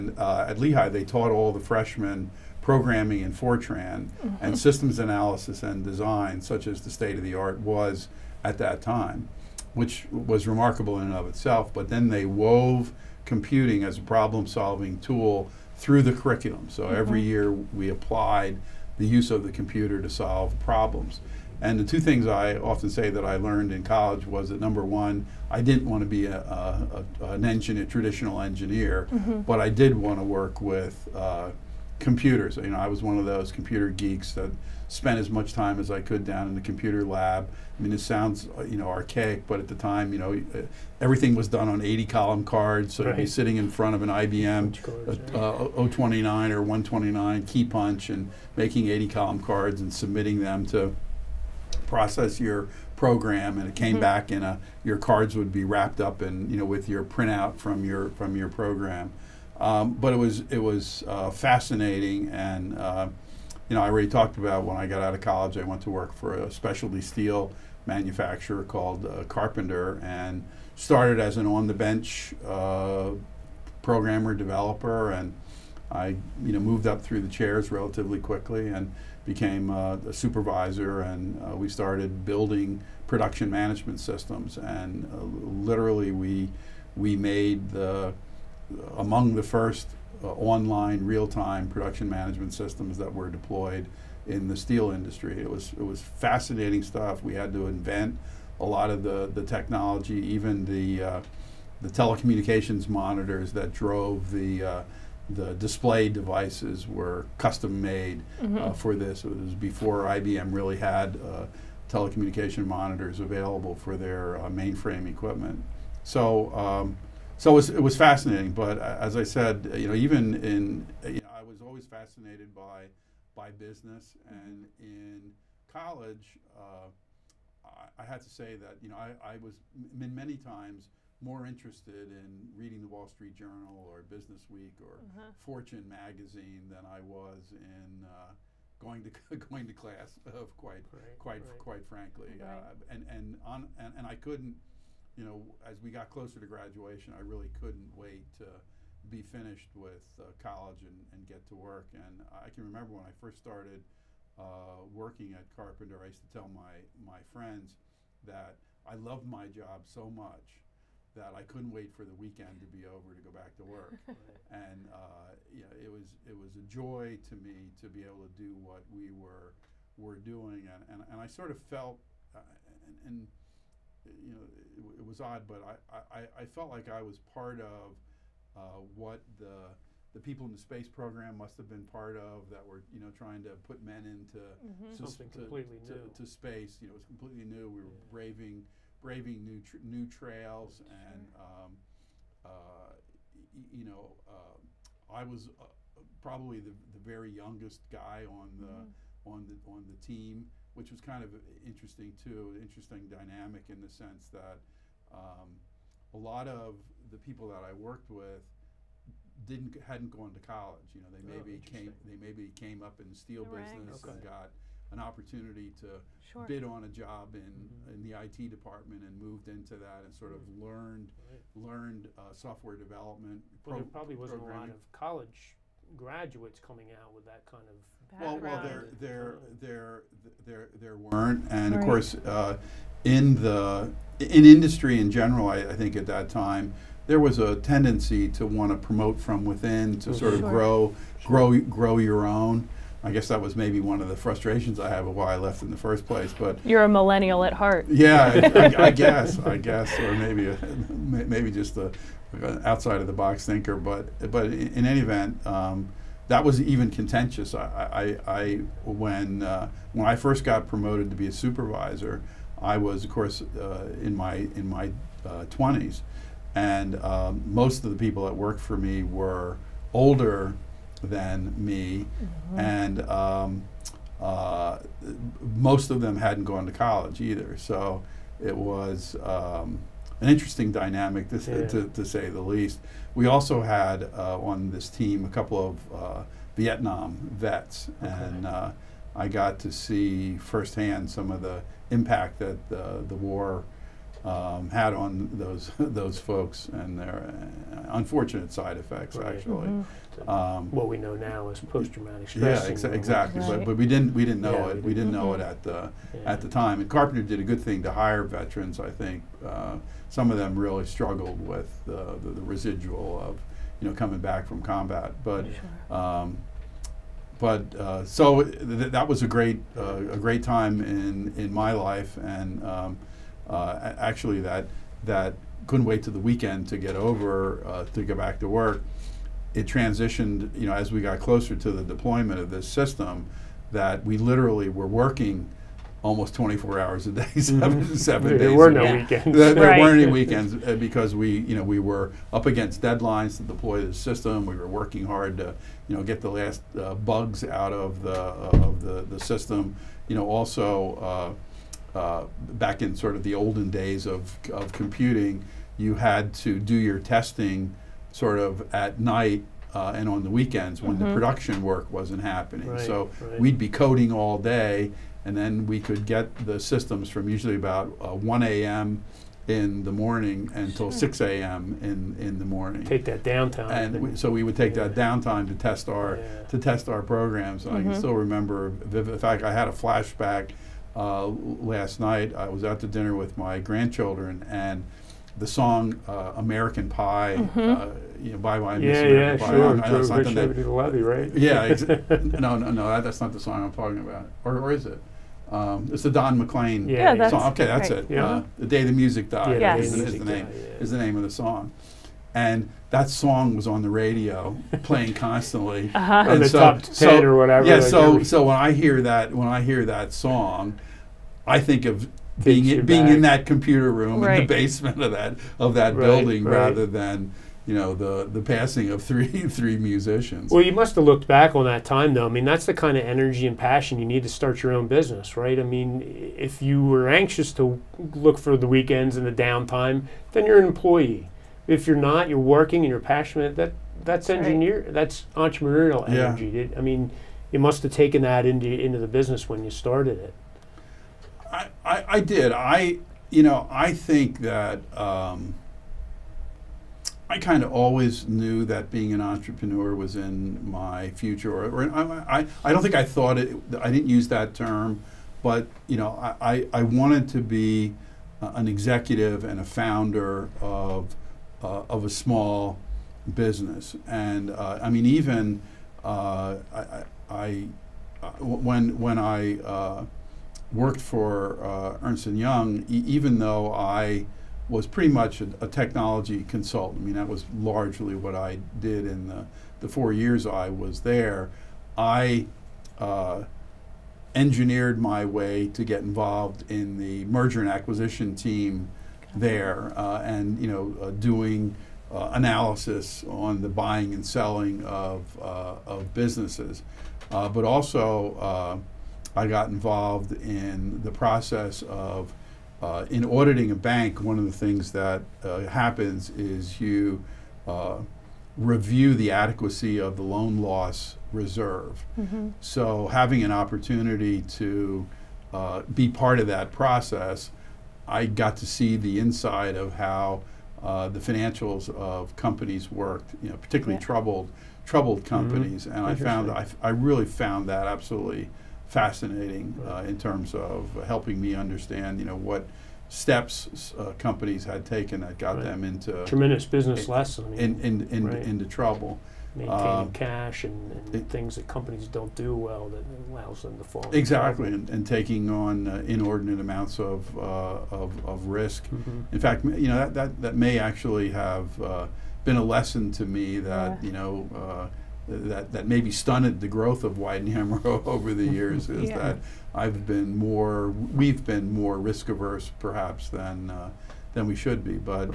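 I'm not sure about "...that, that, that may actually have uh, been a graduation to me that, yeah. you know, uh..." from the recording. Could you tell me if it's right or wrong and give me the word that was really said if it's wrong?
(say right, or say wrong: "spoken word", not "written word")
wrong: "lesson", not "graduation".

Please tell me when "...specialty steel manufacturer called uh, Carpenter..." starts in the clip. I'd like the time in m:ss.
1:06.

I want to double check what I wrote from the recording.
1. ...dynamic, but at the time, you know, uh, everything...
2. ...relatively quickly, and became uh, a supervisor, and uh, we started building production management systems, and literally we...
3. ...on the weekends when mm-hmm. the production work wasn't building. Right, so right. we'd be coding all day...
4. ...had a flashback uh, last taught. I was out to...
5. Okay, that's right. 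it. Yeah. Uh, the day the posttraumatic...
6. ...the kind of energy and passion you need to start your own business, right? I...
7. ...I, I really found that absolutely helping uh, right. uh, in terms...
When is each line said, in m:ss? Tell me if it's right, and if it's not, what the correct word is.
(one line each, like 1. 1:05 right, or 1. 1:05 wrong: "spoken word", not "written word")
1. 0:38 wrong: "archaic", not "dynamic"
2. 1:17 right
3. 6:00 wrong: "happening", not "building"
4. 6:19 wrong: "night", not "taught"
5. 6:37 wrong: "music", not "posttraumatic"
6. 7:02 right
7. 8:46 wrong: "fascinating", not "helping".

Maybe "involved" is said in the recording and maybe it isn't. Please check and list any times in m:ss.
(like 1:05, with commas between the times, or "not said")
8:06, 8:19.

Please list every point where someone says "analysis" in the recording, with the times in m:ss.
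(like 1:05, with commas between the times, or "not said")
0:04, 8:12.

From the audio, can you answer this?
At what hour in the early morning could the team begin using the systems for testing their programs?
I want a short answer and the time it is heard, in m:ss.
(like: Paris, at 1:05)
1 a.m., at 6:08.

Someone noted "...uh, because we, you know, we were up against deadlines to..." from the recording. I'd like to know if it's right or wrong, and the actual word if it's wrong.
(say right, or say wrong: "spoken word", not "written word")
right.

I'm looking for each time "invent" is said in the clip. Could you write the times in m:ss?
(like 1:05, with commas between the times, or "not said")
1:37.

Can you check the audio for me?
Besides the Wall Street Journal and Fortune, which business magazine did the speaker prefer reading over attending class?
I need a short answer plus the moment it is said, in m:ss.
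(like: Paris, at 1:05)
Business Week, at 2:14.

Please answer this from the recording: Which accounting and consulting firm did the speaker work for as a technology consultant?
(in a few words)
Ernst and Young.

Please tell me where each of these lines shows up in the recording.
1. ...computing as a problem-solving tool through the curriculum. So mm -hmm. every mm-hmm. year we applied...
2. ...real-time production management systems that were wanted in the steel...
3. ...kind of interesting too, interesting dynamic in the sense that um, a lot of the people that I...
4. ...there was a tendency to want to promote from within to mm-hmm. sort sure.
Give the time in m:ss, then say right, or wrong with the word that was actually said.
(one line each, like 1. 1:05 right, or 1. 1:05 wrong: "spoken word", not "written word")
1. 0:13 right
2. 1:31 wrong: "deployed", not "wanted"
3. 3:21 right
4. 3:57 right.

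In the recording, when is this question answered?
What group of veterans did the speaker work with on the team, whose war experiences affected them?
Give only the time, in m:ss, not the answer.
4:46.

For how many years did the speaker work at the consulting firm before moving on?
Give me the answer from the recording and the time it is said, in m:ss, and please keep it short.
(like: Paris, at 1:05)
4, at 7:59.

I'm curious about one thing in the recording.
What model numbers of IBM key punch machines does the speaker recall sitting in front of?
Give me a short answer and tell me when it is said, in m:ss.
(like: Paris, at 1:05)
029 or 129, at 0:45.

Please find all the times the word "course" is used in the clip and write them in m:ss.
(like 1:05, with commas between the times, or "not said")
3:51, 4:23.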